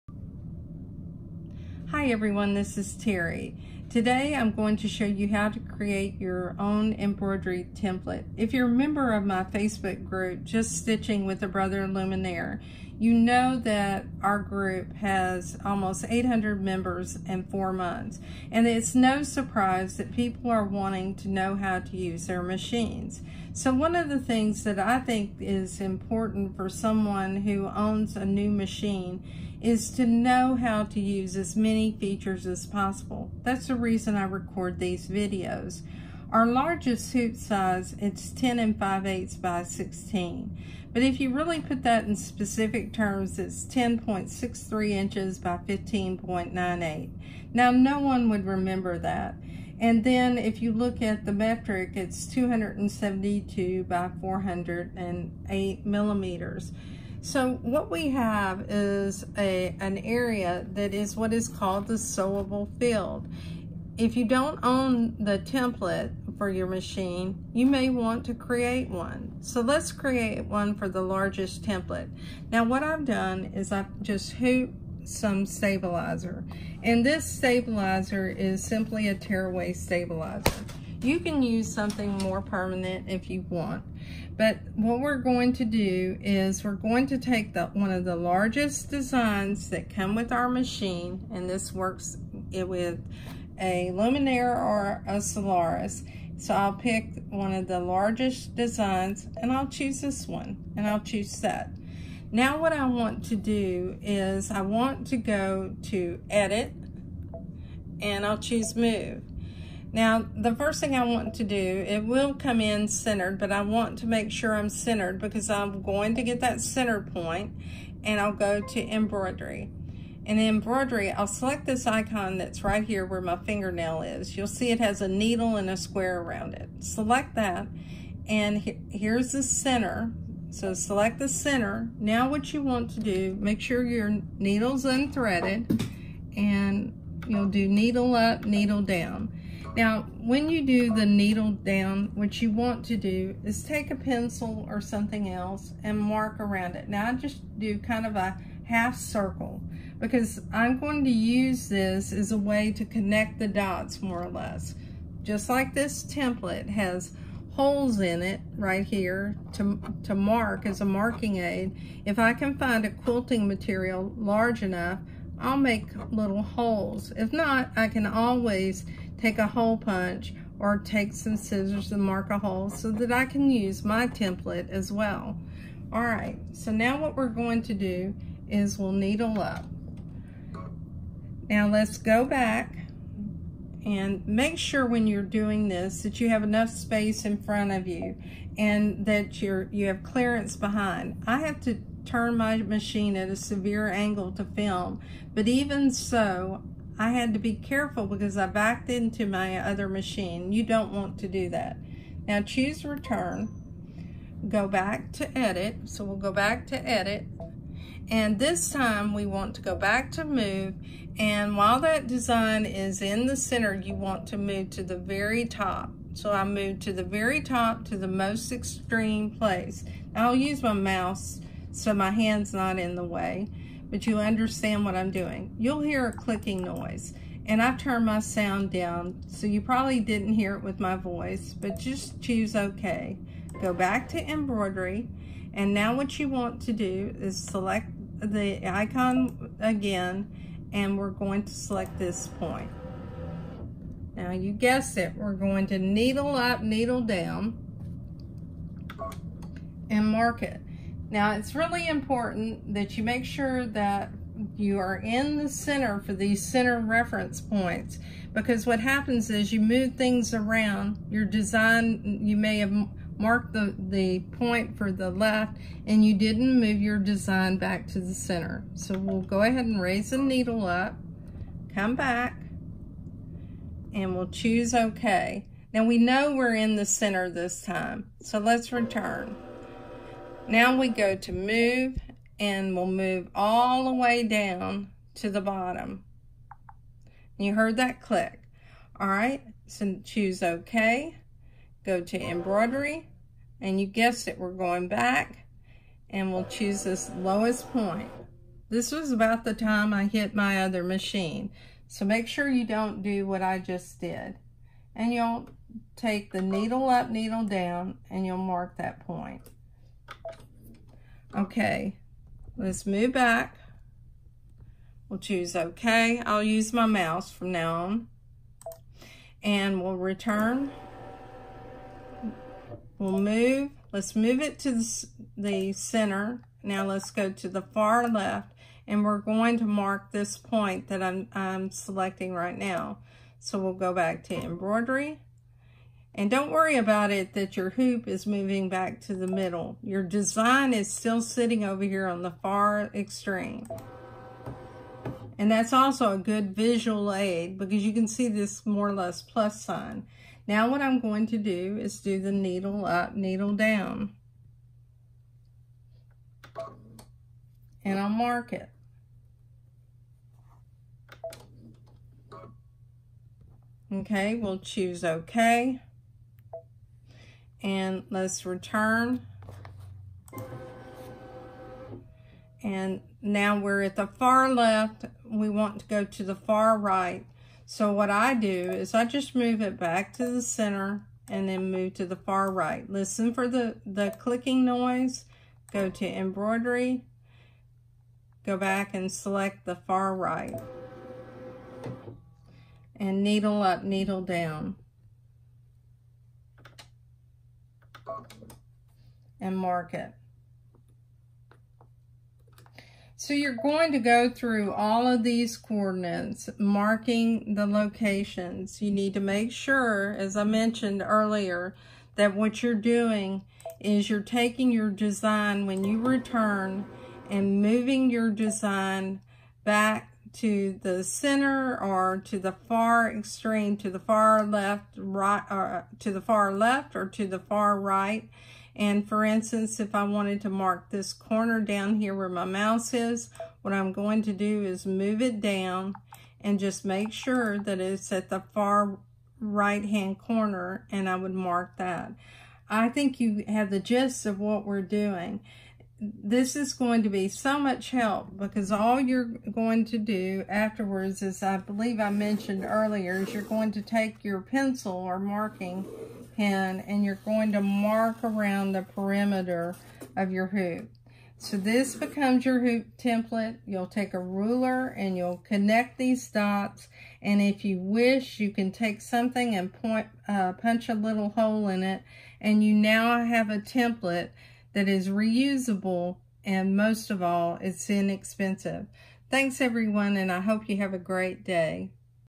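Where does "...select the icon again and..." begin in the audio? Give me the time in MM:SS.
03:57.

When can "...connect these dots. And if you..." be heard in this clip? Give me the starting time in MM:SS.
07:45.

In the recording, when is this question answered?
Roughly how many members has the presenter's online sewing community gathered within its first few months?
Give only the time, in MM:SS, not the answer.
00:15.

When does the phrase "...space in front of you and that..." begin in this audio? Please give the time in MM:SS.
03:06.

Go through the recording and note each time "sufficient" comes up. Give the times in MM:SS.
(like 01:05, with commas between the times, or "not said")
not said.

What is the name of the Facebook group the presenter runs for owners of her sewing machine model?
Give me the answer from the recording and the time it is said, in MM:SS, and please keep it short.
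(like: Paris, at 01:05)
Just Stitching with a Brother Luminaire, at 00:10.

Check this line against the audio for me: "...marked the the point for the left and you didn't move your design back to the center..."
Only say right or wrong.
right.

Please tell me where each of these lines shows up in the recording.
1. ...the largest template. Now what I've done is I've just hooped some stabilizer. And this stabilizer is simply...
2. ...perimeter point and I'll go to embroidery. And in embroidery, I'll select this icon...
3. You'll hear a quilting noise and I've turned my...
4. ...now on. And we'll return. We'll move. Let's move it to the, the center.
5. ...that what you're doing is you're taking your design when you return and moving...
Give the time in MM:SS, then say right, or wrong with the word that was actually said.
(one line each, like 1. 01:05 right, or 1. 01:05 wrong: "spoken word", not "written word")
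1. 01:10 right
2. 01:56 wrong: "center", not "perimeter"
3. 03:45 wrong: "clicking", not "quilting"
4. 05:17 right
5. 06:52 right.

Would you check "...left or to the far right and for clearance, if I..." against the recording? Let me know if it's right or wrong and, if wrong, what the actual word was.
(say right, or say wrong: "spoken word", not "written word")
wrong: "instance", not "clearance".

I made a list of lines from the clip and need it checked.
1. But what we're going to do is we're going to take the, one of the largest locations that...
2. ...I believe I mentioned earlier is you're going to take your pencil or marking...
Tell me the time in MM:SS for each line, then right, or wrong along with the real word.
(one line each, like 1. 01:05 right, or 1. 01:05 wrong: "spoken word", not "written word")
1. 01:24 wrong: "designs", not "locations"
2. 07:31 right.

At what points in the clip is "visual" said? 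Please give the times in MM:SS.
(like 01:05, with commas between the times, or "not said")
05:46.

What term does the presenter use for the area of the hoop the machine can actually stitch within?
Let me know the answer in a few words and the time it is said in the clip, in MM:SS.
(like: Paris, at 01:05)
sewable field, at 01:01.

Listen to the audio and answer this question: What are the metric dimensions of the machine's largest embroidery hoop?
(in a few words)
272 by 408 millimeters.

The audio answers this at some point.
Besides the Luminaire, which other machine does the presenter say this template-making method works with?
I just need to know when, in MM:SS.
01:35.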